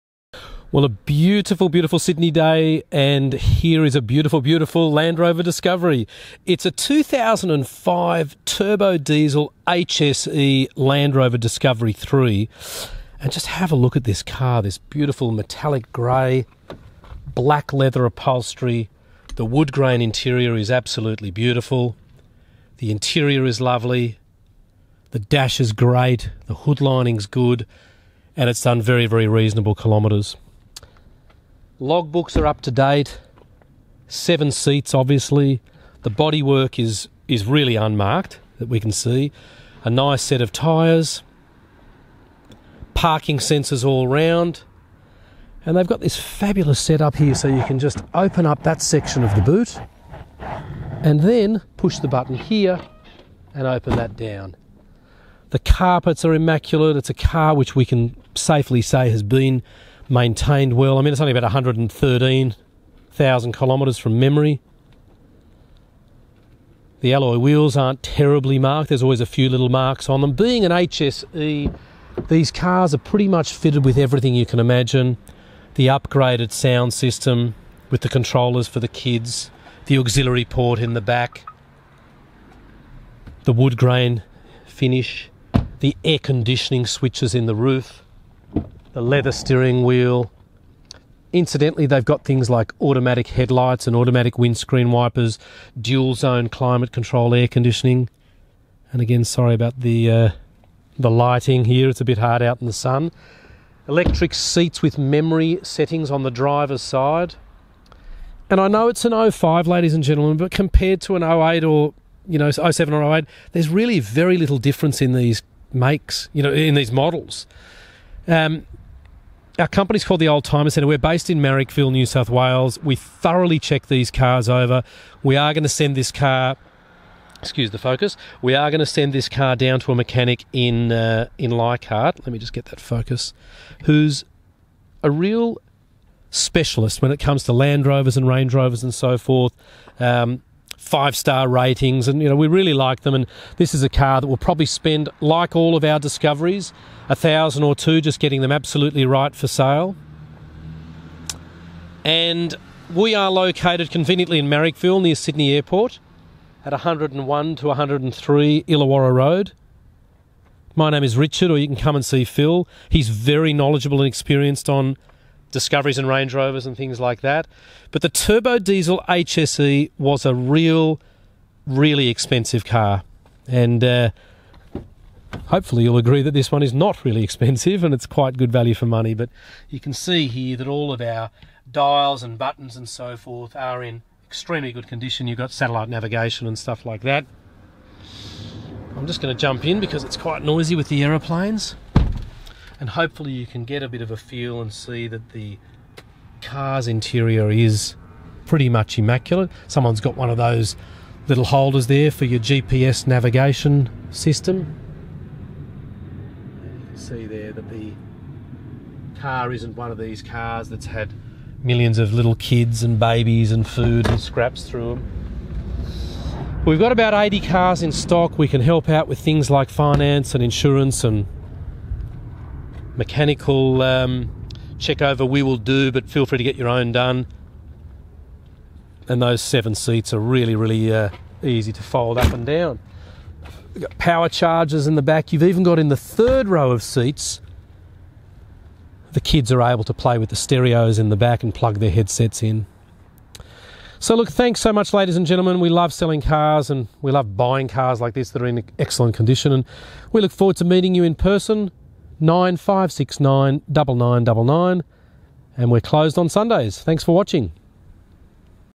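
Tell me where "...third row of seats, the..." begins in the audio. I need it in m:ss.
3:55.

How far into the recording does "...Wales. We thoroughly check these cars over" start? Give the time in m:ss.
2:02.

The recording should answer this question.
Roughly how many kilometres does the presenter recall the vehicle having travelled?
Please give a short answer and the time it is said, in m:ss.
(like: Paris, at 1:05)
113,000, at 1:01.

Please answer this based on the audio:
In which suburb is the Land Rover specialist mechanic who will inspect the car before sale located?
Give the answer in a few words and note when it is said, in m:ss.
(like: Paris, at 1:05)
Leichhardt, at 2:11.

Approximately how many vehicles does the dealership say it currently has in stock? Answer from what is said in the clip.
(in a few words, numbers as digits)
80.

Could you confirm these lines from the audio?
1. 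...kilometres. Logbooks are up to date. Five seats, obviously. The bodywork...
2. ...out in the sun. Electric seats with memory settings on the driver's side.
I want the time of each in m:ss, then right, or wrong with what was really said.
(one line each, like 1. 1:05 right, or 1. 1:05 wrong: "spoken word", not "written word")
1. 0:29 wrong: "Seven", not "Five"
2. 1:42 right.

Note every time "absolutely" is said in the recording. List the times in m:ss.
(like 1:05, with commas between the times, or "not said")
0:20, 2:28.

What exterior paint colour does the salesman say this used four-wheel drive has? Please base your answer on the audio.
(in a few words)
Metallic grey.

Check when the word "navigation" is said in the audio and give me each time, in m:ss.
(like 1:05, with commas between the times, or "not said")
3:05, 3:23.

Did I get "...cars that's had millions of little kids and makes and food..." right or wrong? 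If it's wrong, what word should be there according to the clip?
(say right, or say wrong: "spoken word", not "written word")
wrong: "babies", not "makes".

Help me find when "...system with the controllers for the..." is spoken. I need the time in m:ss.
1:16.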